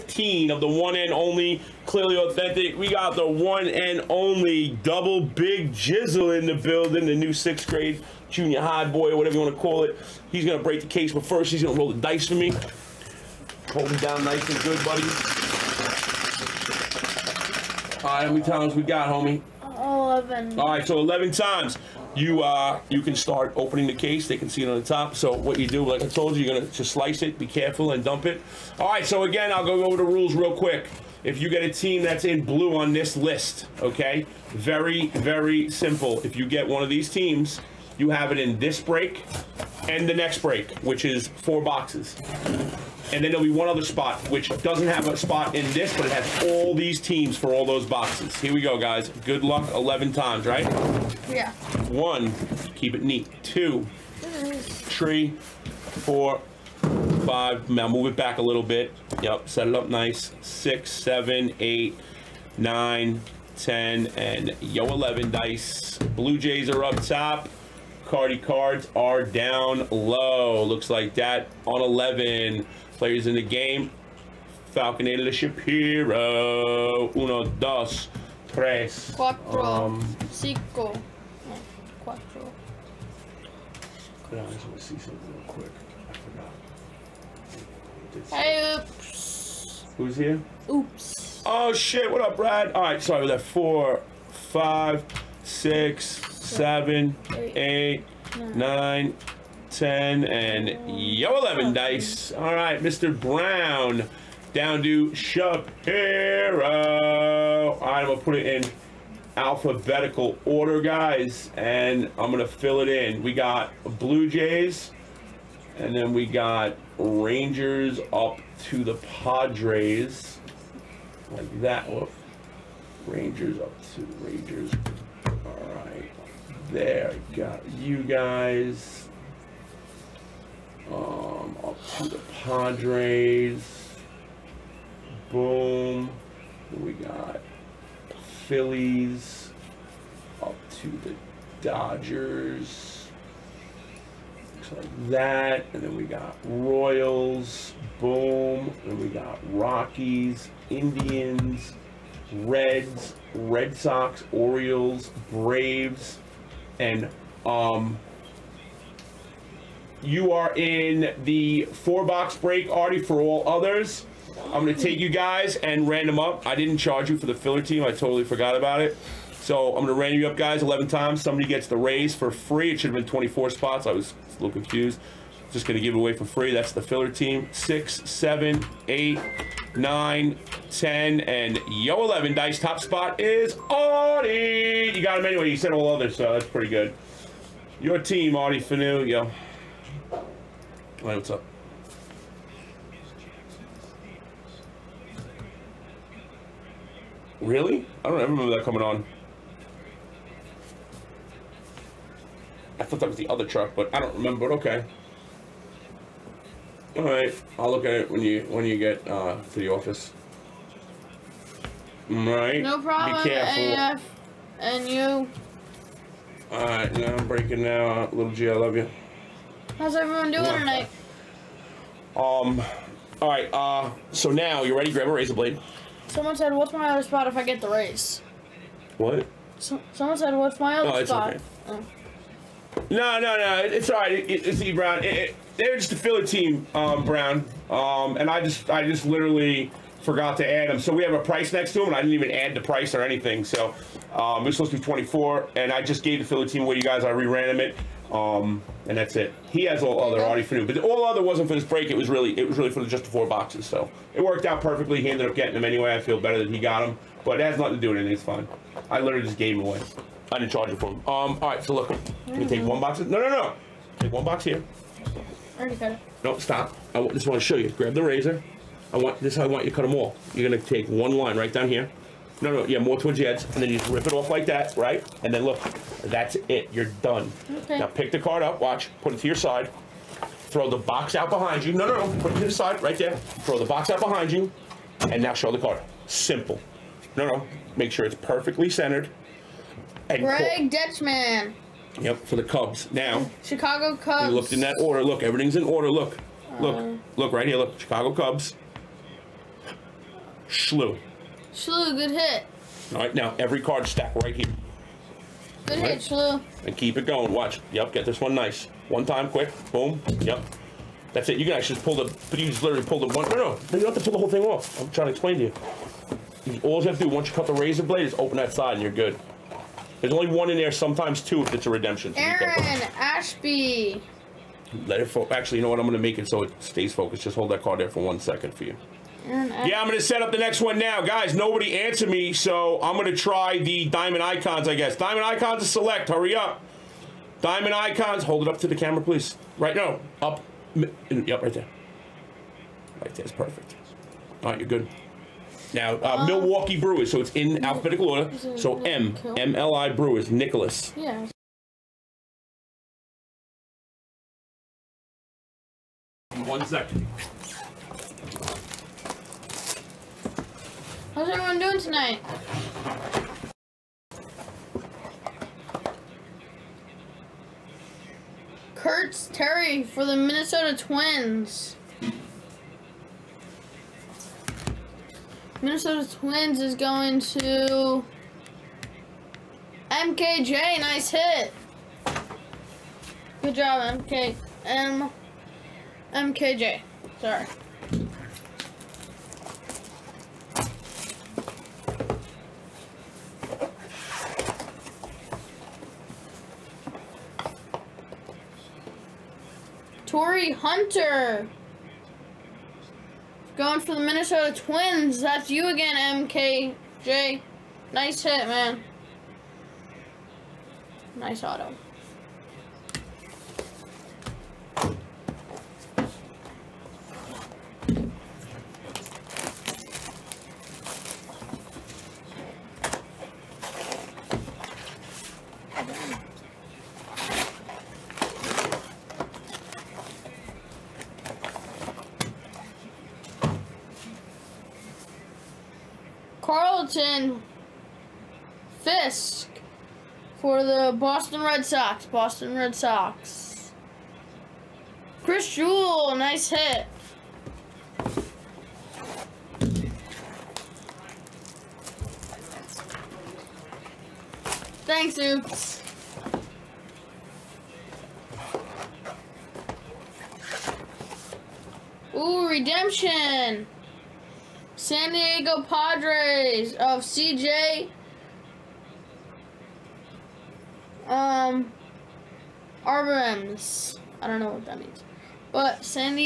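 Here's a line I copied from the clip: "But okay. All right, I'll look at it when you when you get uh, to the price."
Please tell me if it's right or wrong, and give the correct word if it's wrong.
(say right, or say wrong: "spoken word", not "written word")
wrong: "office", not "price".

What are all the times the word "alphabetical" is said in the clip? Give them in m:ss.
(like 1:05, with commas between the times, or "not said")
1:49, 5:47.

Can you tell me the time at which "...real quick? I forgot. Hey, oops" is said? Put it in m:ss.
1:25.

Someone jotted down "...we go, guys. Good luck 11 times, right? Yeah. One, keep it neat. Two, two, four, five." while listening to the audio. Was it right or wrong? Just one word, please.
wrong.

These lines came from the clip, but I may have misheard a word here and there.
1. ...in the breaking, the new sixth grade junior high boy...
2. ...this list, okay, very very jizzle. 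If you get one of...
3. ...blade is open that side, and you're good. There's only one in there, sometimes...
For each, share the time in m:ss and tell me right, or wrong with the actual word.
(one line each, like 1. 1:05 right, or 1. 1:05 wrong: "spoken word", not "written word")
1. 0:06 wrong: "building", not "breaking"
2. 0:32 wrong: "simple", not "jizzle"
3. 5:17 right.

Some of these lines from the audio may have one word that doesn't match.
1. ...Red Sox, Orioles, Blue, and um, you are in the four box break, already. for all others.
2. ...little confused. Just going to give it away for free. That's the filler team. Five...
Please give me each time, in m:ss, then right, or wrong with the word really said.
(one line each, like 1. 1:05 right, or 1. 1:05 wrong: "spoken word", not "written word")
1. 2:33 wrong: "Braves", not "Blue"
2. 2:54 wrong: "Six", not "Five".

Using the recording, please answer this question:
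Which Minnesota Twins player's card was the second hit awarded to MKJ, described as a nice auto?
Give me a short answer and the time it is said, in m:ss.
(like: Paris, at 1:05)
Torii Hunter, at 6:40.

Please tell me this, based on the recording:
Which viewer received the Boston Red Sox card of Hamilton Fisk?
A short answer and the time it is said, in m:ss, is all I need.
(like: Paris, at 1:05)
Chris Jewell, at 7:25.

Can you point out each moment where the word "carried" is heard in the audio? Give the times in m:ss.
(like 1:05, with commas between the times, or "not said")
not said.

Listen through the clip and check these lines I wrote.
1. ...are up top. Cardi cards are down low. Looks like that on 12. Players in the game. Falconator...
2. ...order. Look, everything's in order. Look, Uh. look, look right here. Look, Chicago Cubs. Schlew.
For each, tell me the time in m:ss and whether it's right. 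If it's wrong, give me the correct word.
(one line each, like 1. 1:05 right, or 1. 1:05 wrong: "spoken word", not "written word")
1. 1:06 wrong: "11", not "12"
2. 4:54 right.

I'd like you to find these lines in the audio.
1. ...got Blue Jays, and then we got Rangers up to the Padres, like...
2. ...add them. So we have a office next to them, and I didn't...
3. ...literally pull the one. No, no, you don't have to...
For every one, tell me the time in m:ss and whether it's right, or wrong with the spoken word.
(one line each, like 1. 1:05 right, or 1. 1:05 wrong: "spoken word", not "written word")
1. 1:53 right
2. 4:00 wrong: "price", not "office"
3. 5:12 right.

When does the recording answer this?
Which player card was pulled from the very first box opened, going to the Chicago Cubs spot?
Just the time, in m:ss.
4:50.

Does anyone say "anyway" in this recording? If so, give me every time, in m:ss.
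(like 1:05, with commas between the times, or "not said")
3:05, 4:15.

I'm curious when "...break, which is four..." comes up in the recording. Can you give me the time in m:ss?
0:40.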